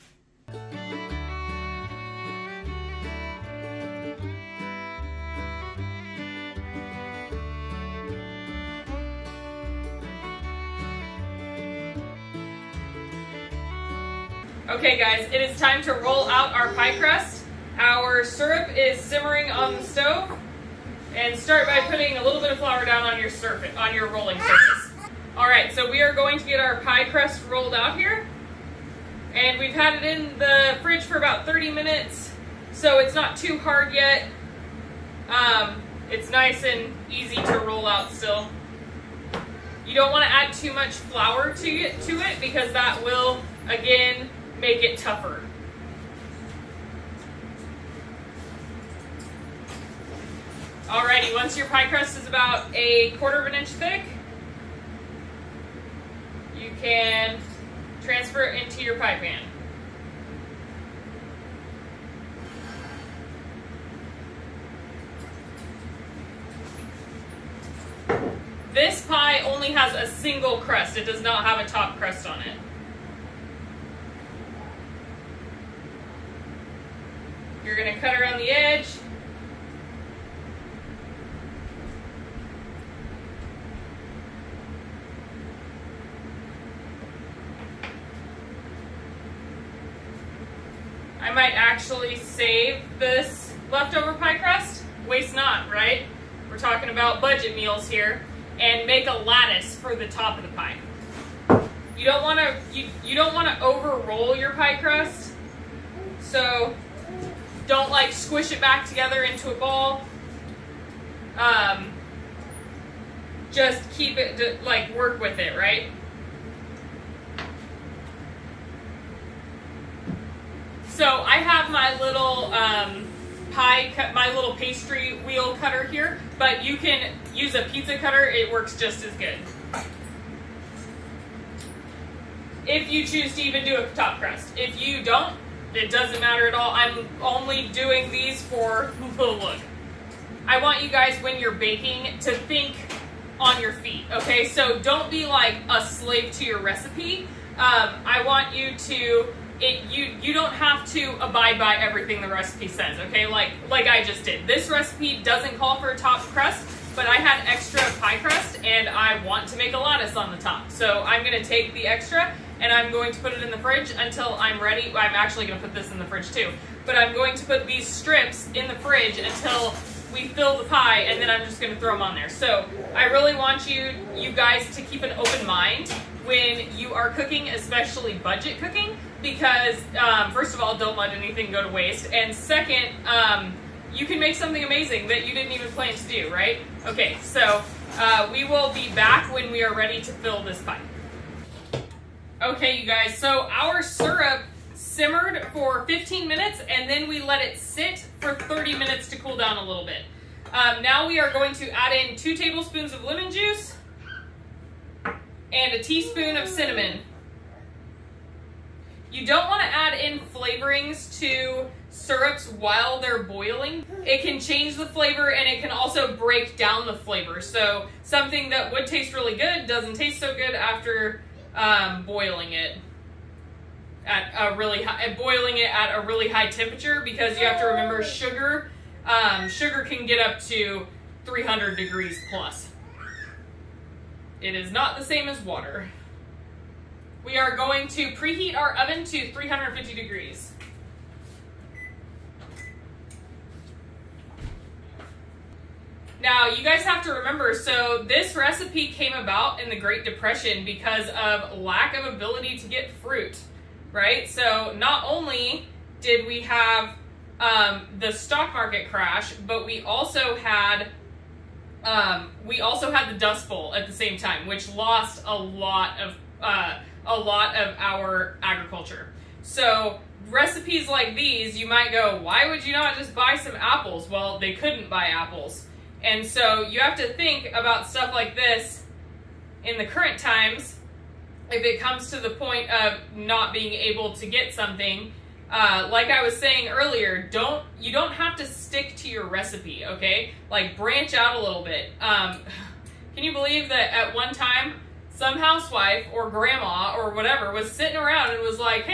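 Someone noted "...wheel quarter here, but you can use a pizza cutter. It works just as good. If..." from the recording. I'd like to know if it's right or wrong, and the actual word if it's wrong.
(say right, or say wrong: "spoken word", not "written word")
wrong: "cutter", not "quarter".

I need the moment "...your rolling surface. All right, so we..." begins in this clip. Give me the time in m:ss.
0:23.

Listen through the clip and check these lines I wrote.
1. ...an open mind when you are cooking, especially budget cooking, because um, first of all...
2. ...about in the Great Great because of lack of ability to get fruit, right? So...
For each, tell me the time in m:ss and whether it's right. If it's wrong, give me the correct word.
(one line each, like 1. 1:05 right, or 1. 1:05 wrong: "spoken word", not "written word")
1. 2:55 right
2. 4:09 wrong: "Depression", not "Great".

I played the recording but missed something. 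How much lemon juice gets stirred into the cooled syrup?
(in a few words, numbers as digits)
2 tablespoons.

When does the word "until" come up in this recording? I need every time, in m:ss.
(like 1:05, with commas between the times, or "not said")
2:43, 2:49.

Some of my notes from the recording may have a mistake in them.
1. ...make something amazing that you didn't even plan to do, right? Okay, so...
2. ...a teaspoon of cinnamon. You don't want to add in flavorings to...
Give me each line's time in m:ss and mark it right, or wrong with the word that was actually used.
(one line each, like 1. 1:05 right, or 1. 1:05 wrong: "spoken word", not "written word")
1. 3:04 right
2. 3:25 right.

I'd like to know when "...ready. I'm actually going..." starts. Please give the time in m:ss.
2:44.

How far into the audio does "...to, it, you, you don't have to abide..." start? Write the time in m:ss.
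2:28.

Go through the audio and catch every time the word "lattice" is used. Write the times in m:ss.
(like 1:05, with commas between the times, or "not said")
1:39, 2:39.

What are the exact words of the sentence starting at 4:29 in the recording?
So recipes like these, you might go, why would you not just buy some apples?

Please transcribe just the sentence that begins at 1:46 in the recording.
So don't like squish it back together into a ball.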